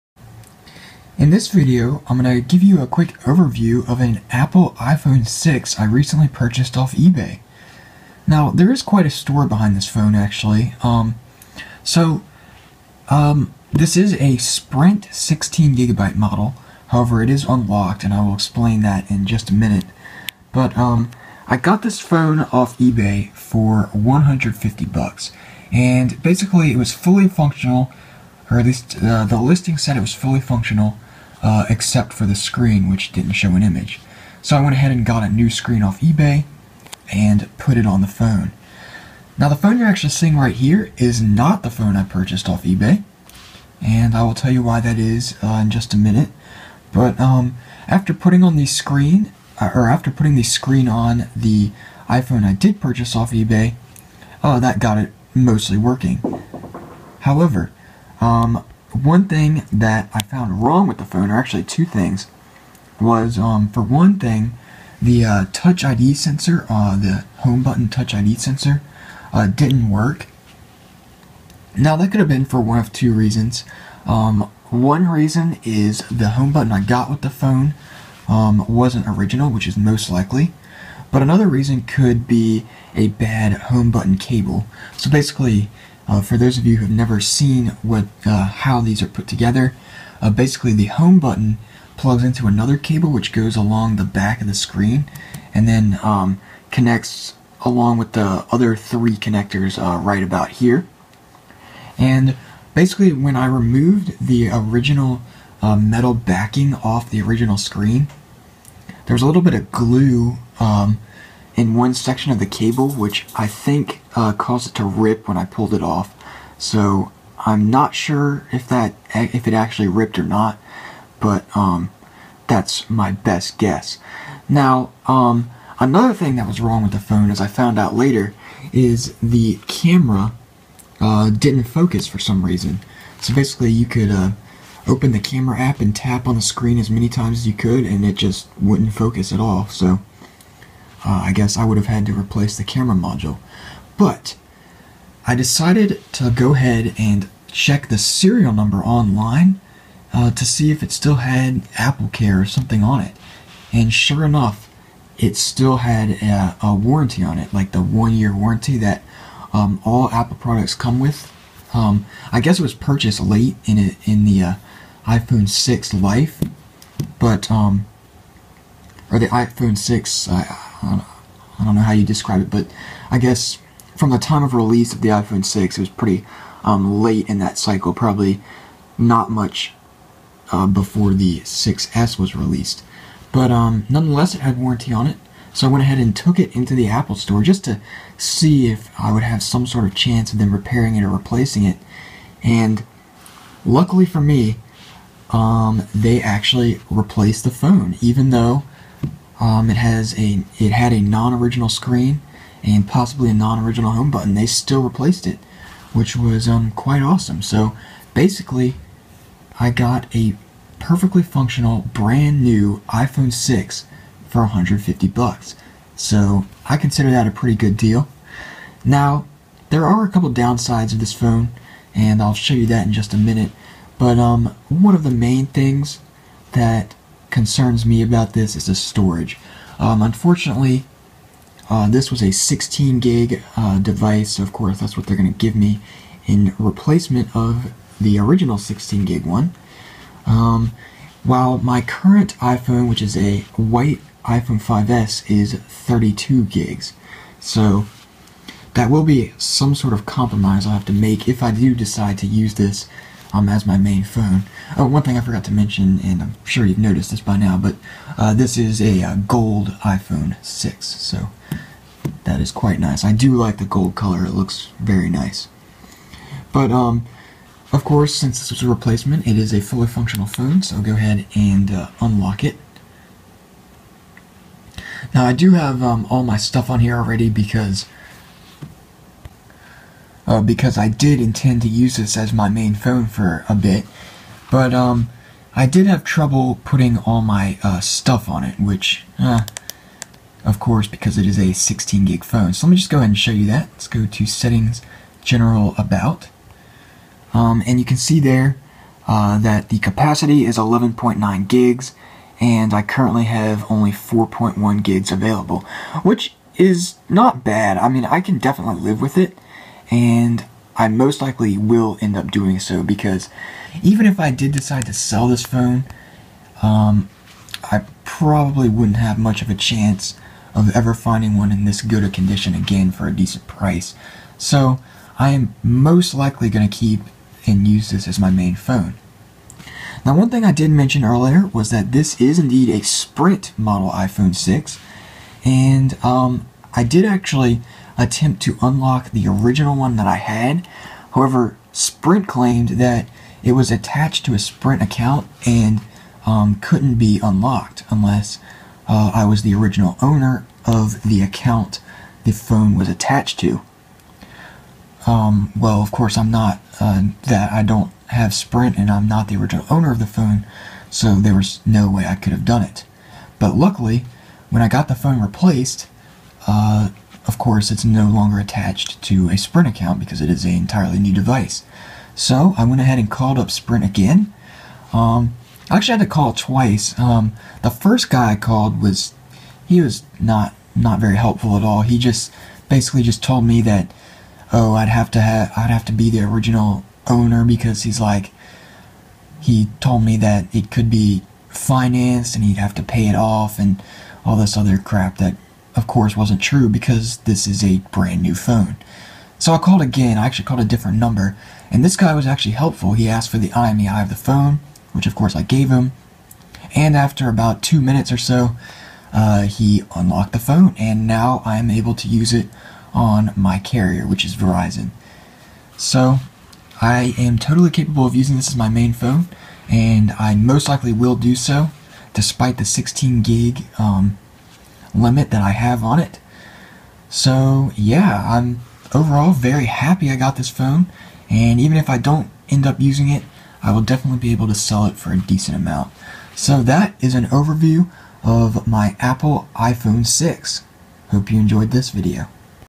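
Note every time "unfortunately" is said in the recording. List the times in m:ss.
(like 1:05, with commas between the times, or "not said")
3:50.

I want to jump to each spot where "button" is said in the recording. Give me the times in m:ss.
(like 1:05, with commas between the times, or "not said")
1:07, 1:16, 1:23, 1:31, 3:24.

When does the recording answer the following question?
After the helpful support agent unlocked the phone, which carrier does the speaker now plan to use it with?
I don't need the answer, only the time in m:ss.
6:54.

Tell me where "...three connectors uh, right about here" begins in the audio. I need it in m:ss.
1:38.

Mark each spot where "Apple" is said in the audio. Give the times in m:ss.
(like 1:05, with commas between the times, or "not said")
0:04, 2:31, 2:40, 3:06, 7:18.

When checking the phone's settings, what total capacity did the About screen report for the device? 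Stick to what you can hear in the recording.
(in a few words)
11.9 GB.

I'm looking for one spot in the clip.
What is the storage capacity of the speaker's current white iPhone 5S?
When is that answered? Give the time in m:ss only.
4:05.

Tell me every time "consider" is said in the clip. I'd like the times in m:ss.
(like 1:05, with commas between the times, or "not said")
3:36.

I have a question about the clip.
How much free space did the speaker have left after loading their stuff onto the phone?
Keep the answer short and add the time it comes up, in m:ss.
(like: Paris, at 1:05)
4.1 GB, at 5:03.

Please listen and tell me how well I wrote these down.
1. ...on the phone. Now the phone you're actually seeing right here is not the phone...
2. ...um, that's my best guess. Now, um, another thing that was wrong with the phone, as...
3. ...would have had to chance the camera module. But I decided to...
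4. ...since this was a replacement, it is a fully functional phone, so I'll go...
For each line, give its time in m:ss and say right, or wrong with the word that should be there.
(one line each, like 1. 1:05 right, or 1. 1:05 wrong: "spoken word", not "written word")
1. 0:37 right
2. 2:01 right
3. 2:21 wrong: "replace", not "chance"
4. 4:28 right.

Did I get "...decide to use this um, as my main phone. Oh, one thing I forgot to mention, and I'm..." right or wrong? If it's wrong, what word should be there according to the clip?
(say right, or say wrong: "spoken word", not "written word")
right.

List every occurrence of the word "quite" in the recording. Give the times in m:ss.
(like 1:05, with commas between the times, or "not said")
0:08, 3:26, 4:22.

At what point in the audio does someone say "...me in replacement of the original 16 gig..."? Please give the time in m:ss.
3:55.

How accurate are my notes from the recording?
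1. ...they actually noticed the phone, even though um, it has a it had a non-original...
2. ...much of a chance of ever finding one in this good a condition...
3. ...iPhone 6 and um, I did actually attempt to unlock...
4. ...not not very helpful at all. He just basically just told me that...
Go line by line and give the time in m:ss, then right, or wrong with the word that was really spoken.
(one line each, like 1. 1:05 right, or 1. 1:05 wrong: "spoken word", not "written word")
1. 3:15 wrong: "replaced", not "noticed"
2. 5:19 right
3. 5:33 right
4. 6:20 right.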